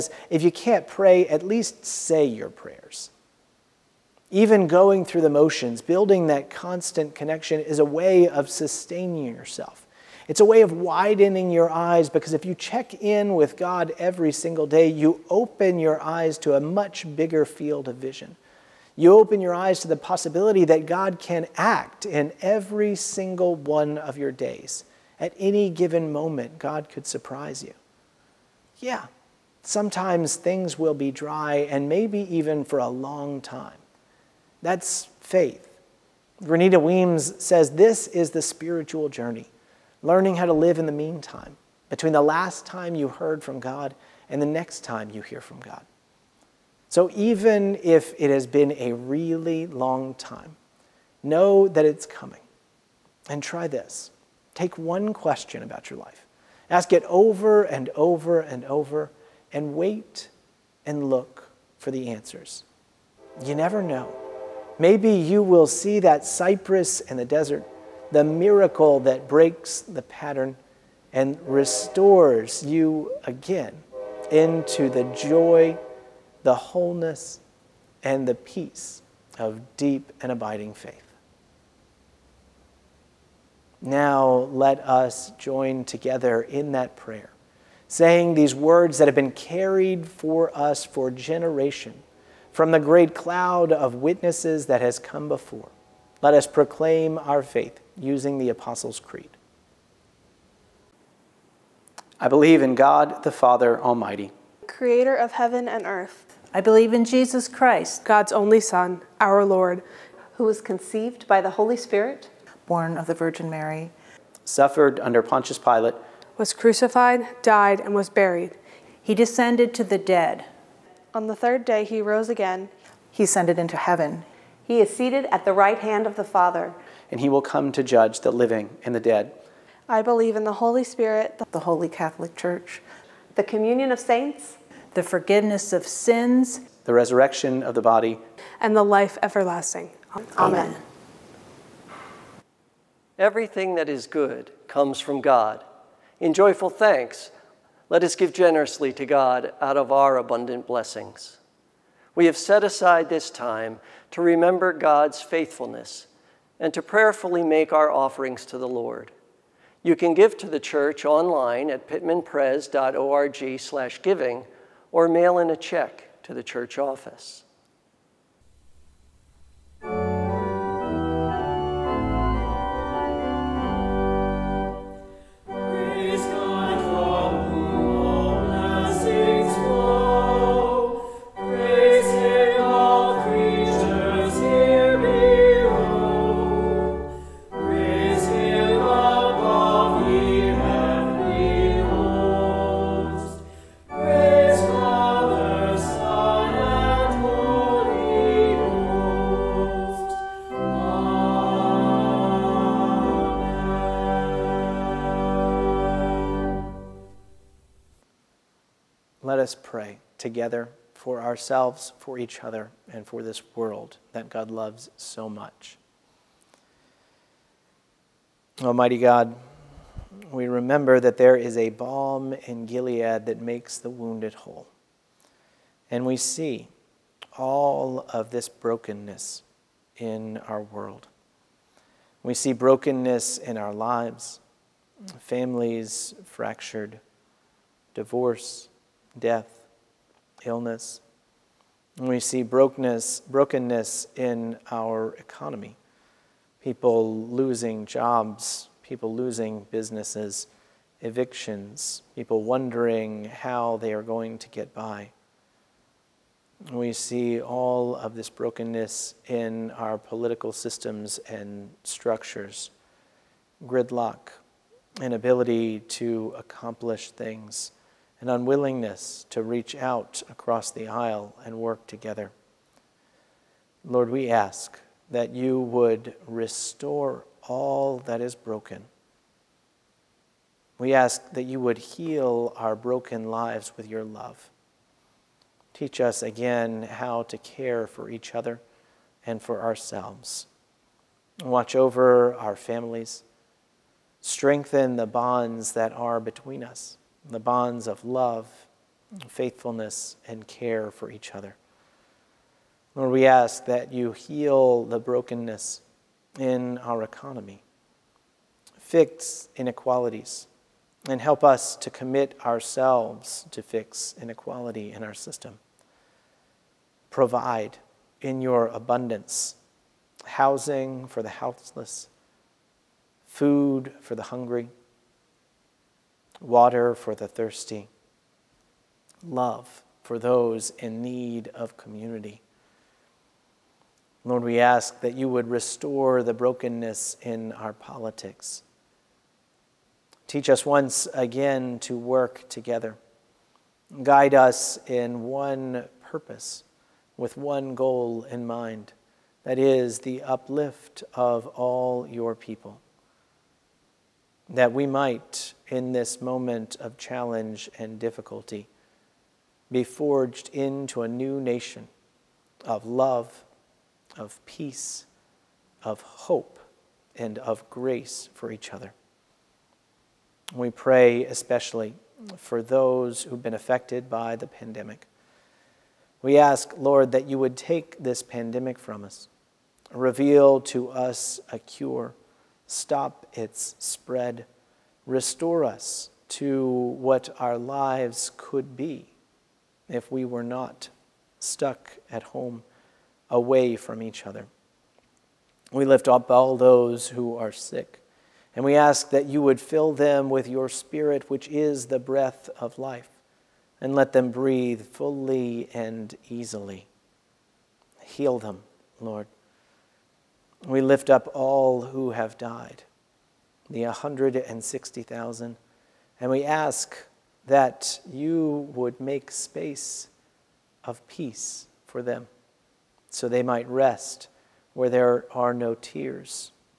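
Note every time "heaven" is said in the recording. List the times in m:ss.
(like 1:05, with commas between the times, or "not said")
1:45, 2:03.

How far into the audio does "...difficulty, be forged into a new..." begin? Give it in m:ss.
5:57.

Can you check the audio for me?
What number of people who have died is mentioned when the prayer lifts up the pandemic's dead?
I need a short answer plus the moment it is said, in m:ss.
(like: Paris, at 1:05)
160,000, at 6:53.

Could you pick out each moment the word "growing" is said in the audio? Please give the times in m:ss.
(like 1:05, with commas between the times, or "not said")
not said.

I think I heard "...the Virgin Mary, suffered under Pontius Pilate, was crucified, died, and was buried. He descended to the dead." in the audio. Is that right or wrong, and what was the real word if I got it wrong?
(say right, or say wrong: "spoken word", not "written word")
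right.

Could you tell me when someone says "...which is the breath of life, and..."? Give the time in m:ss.
6:41.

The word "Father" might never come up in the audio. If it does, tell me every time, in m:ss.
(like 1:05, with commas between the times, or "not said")
1:43, 2:06.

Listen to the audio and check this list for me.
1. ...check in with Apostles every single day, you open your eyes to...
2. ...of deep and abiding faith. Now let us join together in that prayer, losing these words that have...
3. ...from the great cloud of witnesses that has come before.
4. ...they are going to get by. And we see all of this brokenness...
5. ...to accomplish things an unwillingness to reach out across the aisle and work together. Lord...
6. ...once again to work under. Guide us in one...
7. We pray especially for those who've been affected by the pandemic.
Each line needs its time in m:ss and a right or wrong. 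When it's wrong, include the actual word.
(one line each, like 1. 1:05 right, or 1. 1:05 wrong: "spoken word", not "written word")
1. 0:12 wrong: "God", not "Apostles"
2. 1:19 wrong: "saying", not "losing"
3. 1:32 right
4. 4:13 right
5. 4:25 right
6. 5:40 wrong: "together", not "under"
7. 6:10 right.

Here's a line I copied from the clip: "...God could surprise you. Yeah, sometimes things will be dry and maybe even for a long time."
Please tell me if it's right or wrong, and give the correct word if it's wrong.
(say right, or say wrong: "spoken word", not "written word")
right.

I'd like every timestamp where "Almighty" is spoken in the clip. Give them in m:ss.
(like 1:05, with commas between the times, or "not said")
1:43, 3:38.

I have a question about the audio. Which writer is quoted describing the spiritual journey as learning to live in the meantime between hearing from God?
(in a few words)
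Renita Weems.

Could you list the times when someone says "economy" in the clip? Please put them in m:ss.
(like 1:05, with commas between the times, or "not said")
4:05, 5:07.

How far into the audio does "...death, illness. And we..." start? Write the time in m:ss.
3:59.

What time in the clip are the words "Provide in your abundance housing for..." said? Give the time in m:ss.
5:17.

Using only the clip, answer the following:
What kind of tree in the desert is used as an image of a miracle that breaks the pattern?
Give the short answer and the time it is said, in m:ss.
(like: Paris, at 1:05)
cypress, at 1:06.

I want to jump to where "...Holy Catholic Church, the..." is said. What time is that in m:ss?
2:11.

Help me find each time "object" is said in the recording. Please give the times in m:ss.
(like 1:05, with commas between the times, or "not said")
not said.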